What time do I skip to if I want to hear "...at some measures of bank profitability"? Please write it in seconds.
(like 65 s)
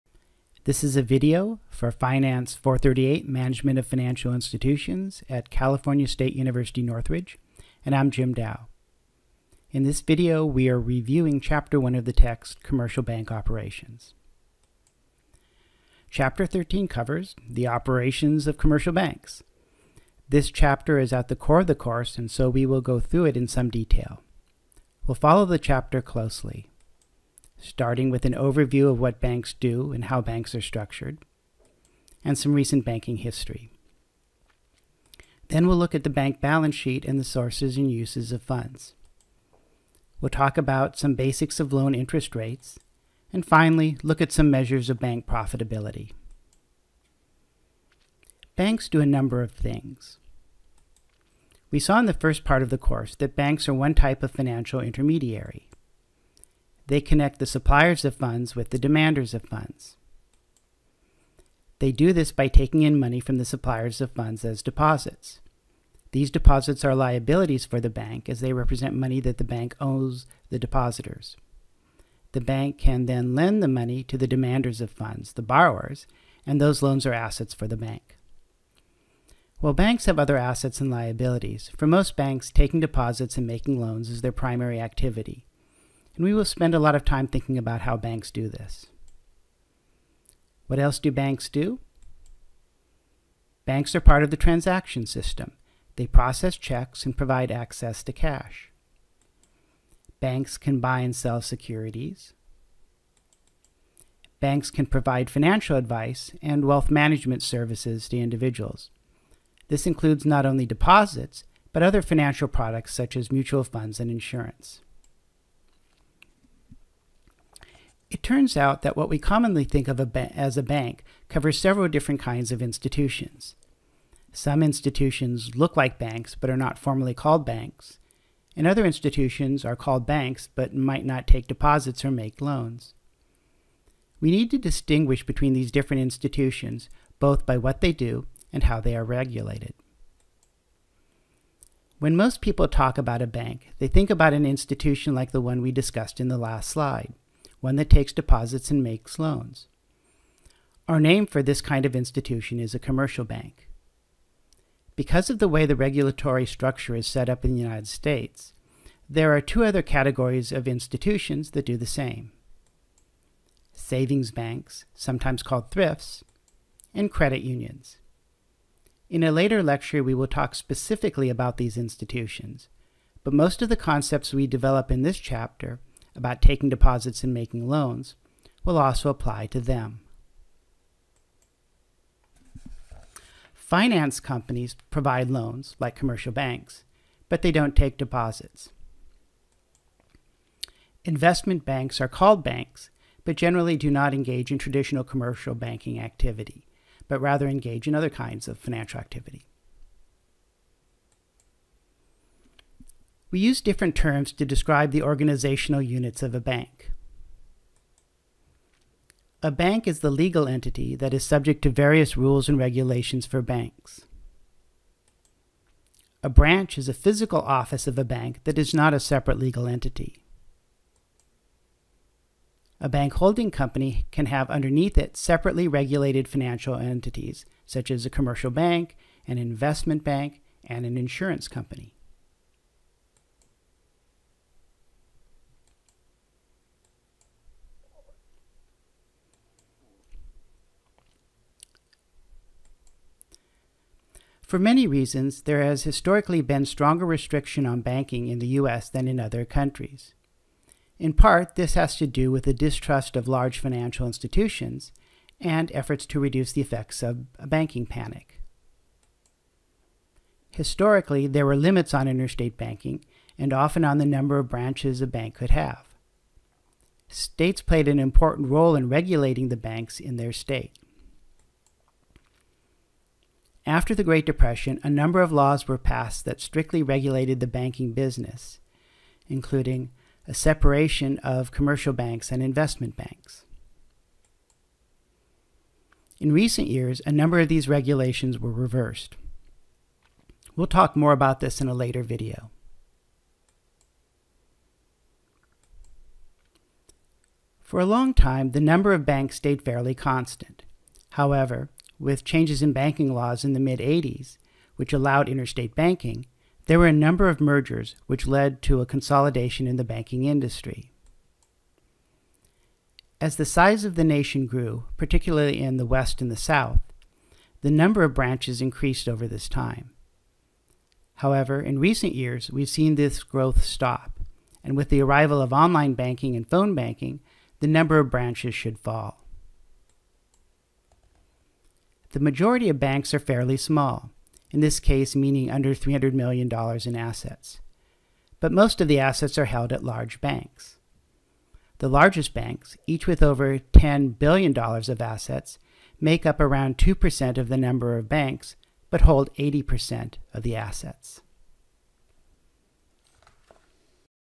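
44 s.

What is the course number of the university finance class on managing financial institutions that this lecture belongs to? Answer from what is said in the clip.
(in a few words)
438.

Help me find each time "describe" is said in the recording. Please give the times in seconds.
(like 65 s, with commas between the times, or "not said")
204 s.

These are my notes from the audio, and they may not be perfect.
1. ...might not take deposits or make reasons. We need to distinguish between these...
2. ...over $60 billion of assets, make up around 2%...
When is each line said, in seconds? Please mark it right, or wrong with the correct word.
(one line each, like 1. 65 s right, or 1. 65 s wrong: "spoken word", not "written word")
1. 130 s wrong: "loans", not "reasons"
2. 343 s wrong: "10", not "60".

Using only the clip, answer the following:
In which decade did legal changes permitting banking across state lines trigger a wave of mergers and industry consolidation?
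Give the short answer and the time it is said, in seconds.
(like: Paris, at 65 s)
mid 80s, at 303 s.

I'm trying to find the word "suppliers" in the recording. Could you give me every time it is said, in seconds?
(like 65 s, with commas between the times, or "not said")
57 s, 63 s.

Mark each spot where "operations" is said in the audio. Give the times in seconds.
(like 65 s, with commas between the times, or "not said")
13 s, 17 s.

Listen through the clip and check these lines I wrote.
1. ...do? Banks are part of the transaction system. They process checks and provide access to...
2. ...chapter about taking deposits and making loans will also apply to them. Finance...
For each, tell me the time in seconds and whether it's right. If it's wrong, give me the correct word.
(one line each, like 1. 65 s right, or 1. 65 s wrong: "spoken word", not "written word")
1. 91 s right
2. 175 s right.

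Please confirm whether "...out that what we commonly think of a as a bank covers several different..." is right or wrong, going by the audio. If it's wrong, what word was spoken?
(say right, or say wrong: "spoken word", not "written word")
right.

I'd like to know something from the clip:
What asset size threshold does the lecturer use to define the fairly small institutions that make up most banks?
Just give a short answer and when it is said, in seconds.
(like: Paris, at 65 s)
$300 million, at 335 s.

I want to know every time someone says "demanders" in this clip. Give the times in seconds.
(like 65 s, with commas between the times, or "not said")
58 s, 74 s.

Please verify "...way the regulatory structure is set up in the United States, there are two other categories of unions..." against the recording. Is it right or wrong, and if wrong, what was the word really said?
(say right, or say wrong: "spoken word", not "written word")
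wrong: "institutions", not "unions".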